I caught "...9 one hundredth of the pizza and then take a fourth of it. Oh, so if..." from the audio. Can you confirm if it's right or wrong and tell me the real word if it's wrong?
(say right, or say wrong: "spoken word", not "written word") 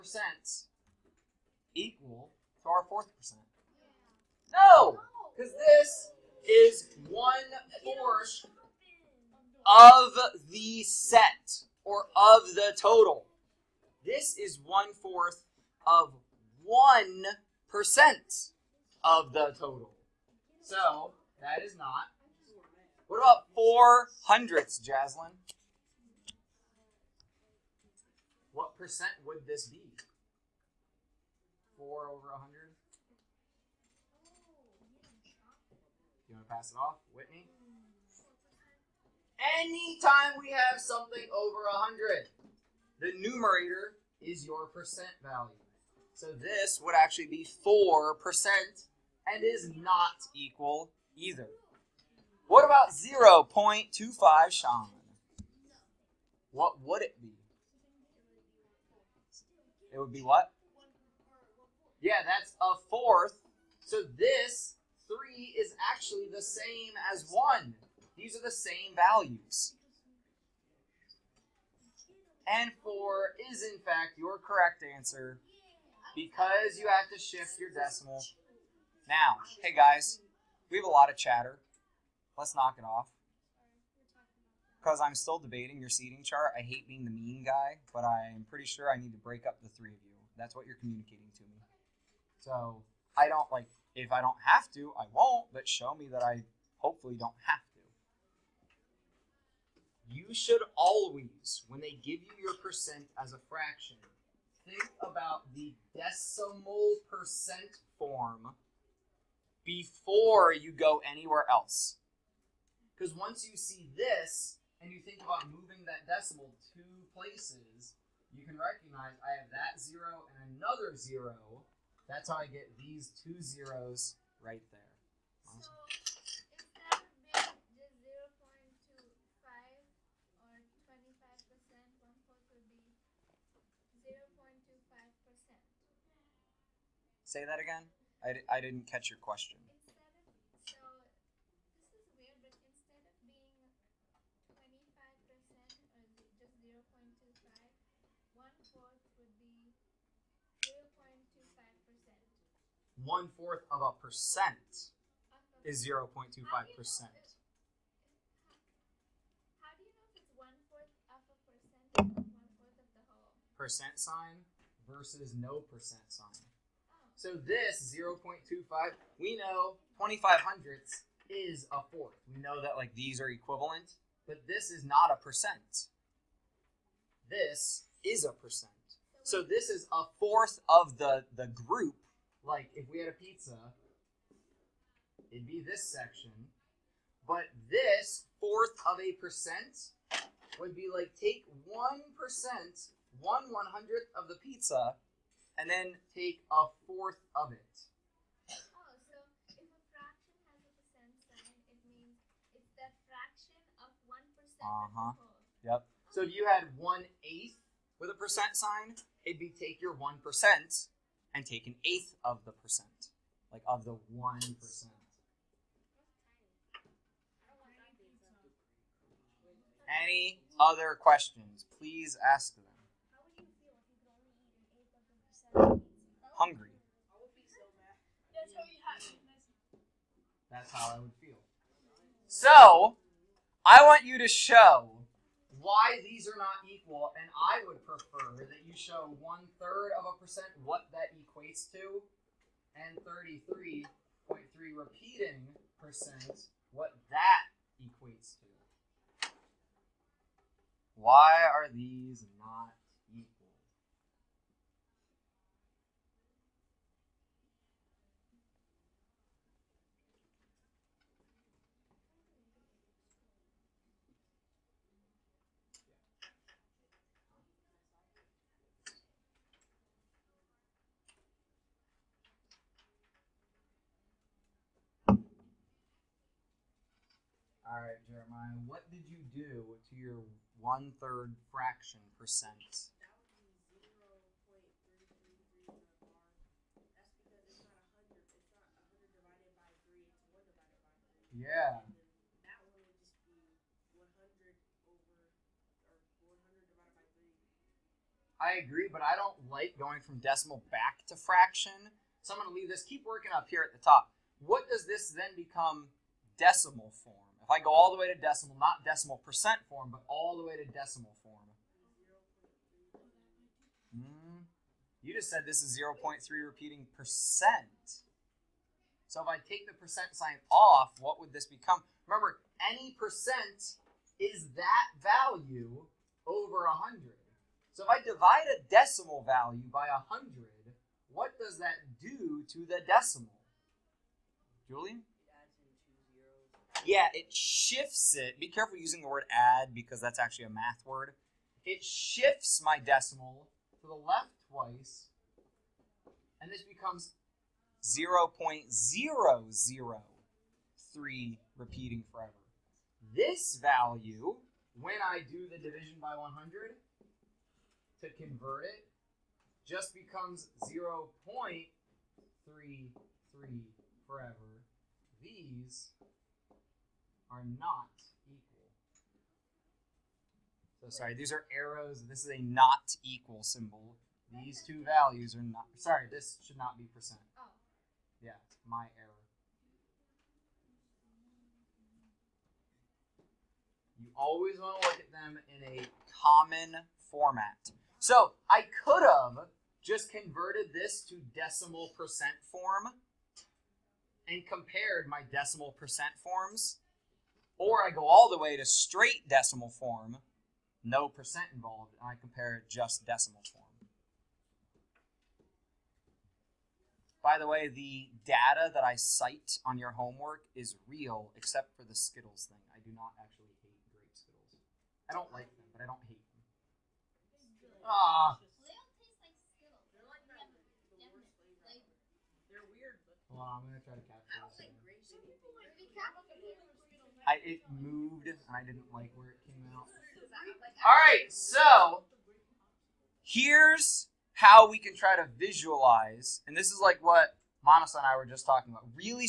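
wrong: "1", not "9".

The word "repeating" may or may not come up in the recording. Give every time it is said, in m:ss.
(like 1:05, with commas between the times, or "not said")
4:04, 5:16, 5:51.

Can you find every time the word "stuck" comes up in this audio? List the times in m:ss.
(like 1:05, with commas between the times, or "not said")
not said.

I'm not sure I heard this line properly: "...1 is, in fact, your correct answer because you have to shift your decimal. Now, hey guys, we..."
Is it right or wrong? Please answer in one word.
wrong.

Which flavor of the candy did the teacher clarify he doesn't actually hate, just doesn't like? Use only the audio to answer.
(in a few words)
Grape.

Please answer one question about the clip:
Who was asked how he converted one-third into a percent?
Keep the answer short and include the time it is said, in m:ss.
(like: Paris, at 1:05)
Jeremiah, at 4:38.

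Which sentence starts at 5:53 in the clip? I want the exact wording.
This value, when I do the division by 100 to convert it, just becomes 0.33 forever.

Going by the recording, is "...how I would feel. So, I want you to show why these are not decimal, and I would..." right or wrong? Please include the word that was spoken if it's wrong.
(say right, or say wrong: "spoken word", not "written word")
wrong: "equal", not "decimal".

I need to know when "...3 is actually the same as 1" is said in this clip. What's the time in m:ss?
1:05.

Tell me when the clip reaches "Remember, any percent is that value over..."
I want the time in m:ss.
5:22.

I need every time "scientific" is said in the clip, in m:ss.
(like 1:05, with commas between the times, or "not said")
not said.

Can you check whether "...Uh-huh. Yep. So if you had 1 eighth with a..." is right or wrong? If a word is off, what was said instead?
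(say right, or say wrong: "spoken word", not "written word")
right.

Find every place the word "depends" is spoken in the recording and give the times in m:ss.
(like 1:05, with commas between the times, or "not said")
not said.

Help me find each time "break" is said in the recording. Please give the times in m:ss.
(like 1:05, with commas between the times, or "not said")
1:29.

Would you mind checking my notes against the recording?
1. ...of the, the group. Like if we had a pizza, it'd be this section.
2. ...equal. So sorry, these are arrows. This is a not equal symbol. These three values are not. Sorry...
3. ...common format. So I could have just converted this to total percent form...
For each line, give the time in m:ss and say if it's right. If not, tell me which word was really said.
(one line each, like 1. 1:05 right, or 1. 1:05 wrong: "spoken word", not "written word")
1. 3:00 right
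2. 6:08 wrong: "two", not "three"
3. 6:26 wrong: "decimal", not "total".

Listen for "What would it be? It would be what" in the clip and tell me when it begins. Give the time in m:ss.
0:56.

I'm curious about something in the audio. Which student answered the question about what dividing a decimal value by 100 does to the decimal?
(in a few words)
Julian.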